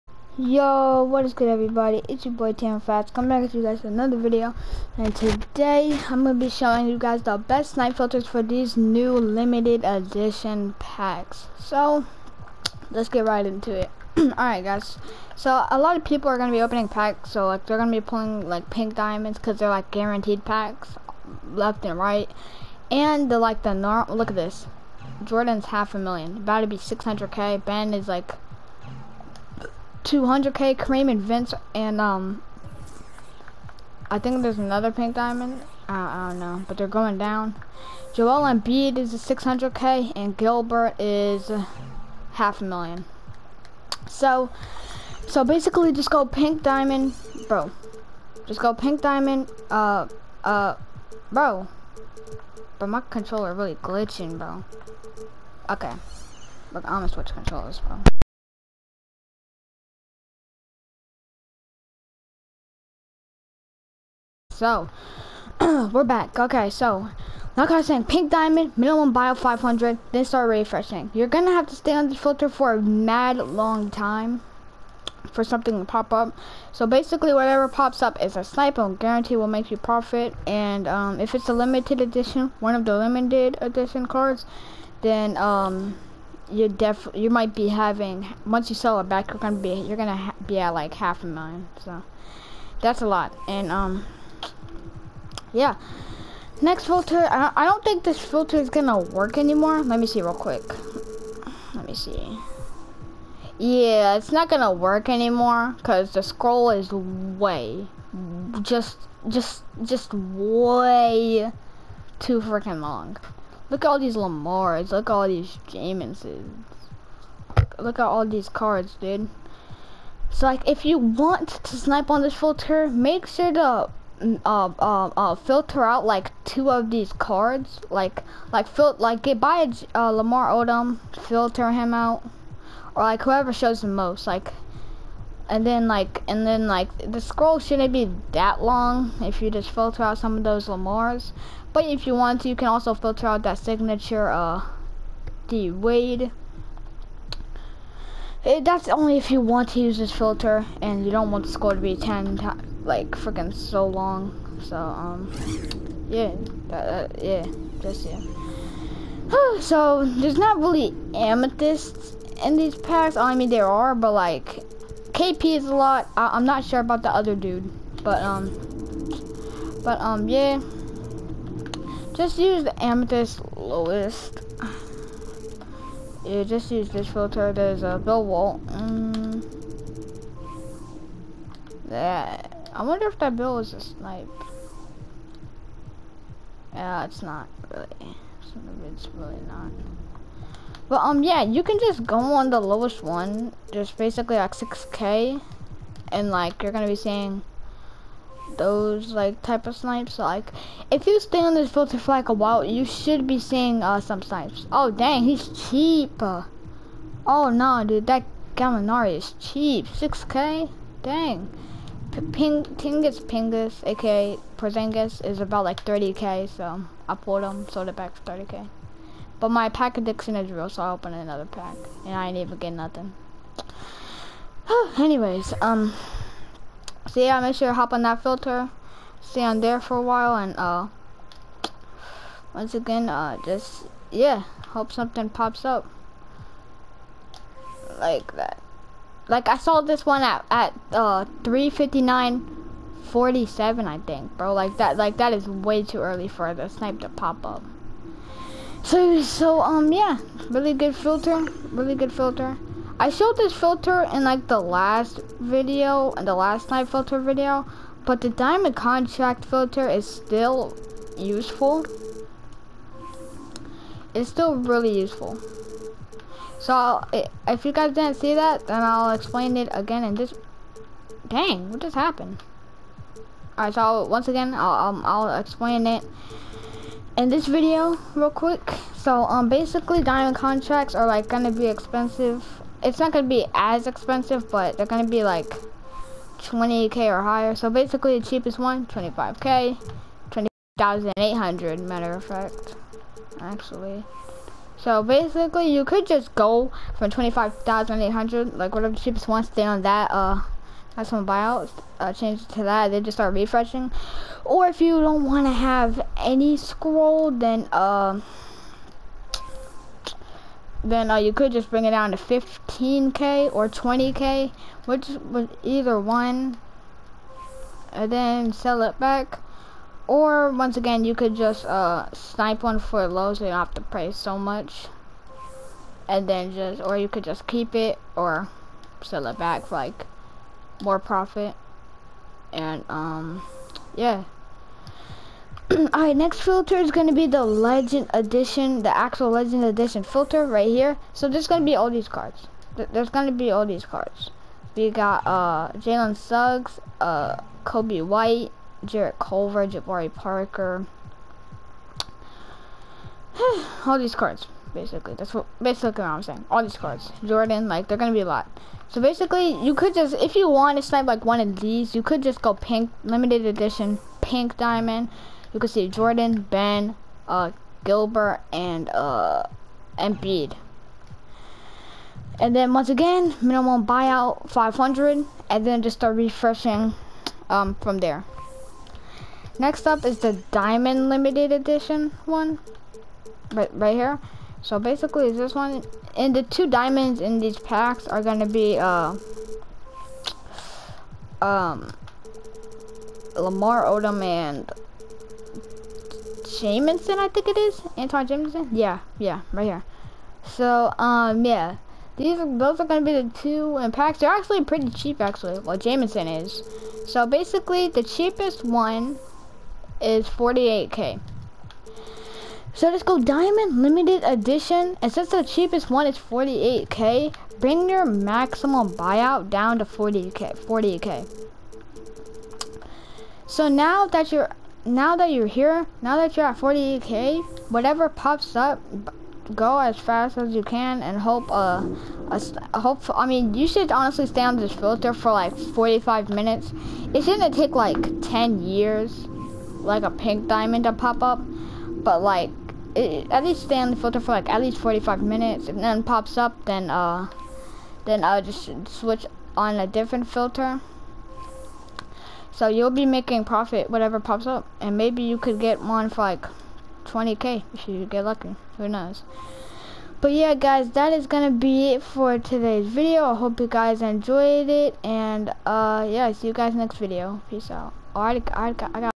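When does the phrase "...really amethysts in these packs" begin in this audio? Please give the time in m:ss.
2:40.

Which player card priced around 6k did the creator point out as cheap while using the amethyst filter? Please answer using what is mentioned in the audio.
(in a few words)
Gallinari.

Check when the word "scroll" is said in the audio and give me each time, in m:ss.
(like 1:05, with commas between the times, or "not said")
1:46, 2:17, 5:06.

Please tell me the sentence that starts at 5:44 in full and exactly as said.
We got uh, Jalen Suggs, uh, Kobe White, Jarrett Culver, Jabari Parker.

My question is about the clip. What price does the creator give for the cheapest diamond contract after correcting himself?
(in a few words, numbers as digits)
20,800.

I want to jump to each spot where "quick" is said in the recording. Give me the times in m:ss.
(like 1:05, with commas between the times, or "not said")
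1:40, 4:38.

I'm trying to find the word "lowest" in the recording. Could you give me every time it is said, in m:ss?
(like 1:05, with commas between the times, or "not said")
2:53, 3:12.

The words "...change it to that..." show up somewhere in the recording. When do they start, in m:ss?
5:02.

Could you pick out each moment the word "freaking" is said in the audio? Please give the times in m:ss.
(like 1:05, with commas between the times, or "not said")
1:52, 2:33.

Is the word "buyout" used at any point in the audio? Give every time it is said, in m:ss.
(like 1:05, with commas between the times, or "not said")
5:01, 6:13, 6:58.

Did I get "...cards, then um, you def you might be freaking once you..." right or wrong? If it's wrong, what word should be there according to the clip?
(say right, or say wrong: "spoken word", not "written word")
wrong: "having", not "freaking".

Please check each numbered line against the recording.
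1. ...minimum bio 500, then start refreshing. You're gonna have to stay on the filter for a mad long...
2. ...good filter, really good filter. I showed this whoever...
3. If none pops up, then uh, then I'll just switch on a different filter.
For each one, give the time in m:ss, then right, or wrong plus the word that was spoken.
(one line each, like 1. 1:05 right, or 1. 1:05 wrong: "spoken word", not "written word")
1. 1:08 right
2. 4:10 wrong: "filter", not "whoever"
3. 7:25 right.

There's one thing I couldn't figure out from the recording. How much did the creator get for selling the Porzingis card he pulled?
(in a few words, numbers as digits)
30k.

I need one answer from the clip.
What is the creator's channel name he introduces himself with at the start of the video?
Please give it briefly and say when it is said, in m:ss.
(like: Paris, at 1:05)
Tam Fats, at 0:02.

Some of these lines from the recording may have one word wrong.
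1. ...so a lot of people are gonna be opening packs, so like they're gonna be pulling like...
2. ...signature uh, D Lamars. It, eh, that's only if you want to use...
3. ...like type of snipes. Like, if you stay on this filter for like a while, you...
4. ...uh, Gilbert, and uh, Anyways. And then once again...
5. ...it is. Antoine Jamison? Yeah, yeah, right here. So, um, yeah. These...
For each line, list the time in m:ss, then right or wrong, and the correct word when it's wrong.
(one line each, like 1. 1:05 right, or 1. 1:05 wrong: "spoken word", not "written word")
1. 0:15 right
2. 2:23 wrong: "Wade", not "Lamars"
3. 3:19 right
4. 6:07 wrong: "Embiid", not "Anyways"
5. 6:37 right.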